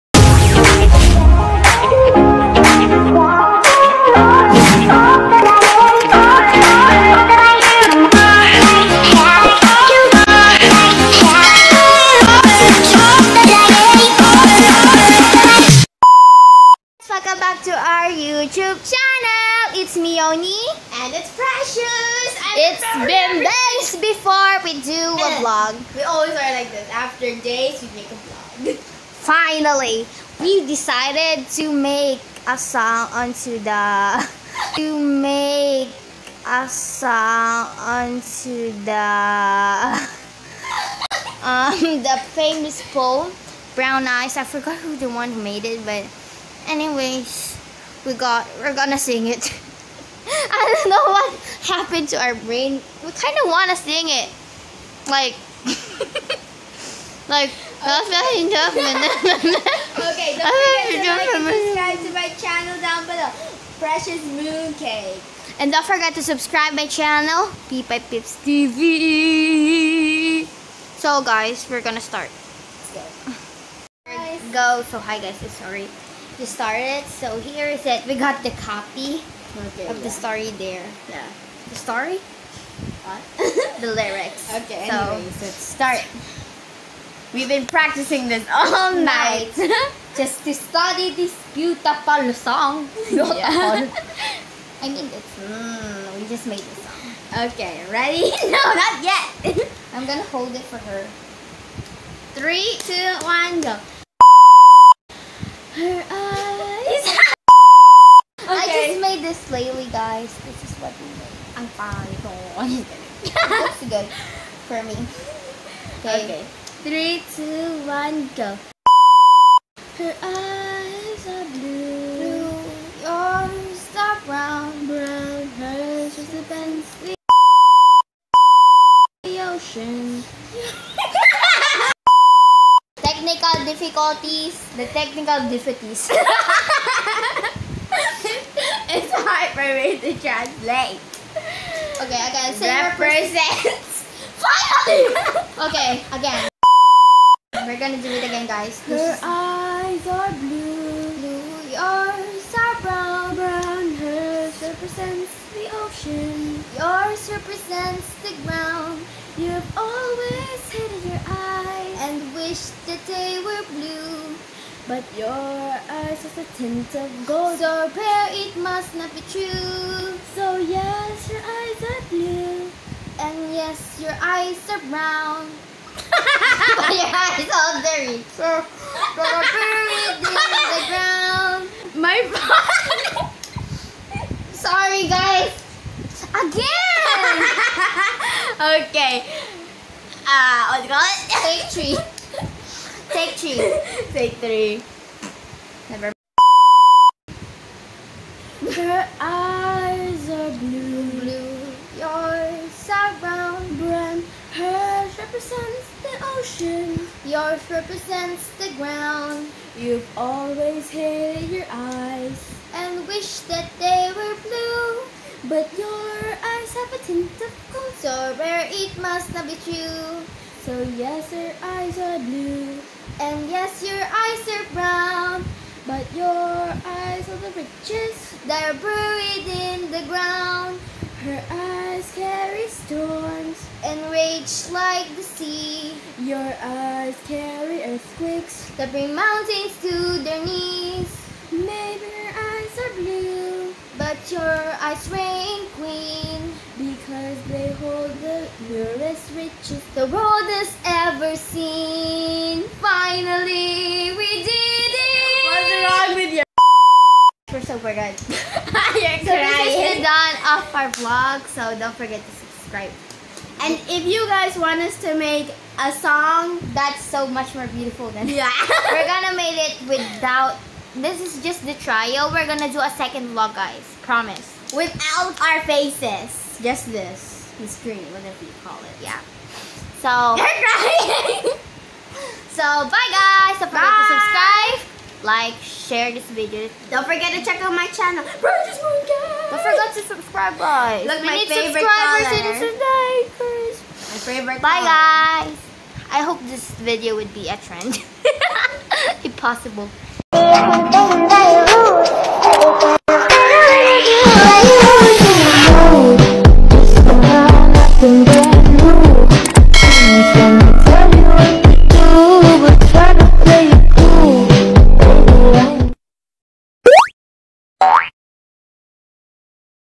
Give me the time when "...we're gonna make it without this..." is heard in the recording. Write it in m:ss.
4:28.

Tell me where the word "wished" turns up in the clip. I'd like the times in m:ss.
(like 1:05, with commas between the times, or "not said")
2:42, 3:33.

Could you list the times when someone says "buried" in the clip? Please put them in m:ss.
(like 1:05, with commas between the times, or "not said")
2:59, 3:48.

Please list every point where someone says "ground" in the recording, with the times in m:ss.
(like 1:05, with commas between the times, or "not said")
2:38, 3:00, 3:28, 3:50.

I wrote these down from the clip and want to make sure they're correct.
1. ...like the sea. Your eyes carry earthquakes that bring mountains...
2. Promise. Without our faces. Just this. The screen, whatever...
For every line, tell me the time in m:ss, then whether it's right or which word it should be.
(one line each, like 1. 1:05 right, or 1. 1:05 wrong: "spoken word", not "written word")
1. 3:54 right
2. 4:34 right.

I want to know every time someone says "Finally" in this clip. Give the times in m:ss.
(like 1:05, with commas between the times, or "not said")
0:29, 2:24, 4:13.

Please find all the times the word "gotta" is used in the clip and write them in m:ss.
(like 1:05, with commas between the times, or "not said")
2:22.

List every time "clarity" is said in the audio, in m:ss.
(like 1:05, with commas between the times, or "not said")
not said.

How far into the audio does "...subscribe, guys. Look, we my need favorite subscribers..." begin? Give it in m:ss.
4:50.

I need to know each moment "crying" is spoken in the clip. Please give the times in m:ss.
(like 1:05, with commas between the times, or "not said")
4:18, 4:40.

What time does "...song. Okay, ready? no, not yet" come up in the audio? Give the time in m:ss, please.
1:36.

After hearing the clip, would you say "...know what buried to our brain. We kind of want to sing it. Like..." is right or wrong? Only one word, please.
wrong.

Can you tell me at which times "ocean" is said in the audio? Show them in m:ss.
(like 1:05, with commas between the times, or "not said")
2:09, 2:35, 3:26.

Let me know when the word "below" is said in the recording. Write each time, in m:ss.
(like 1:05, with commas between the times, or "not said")
1:03.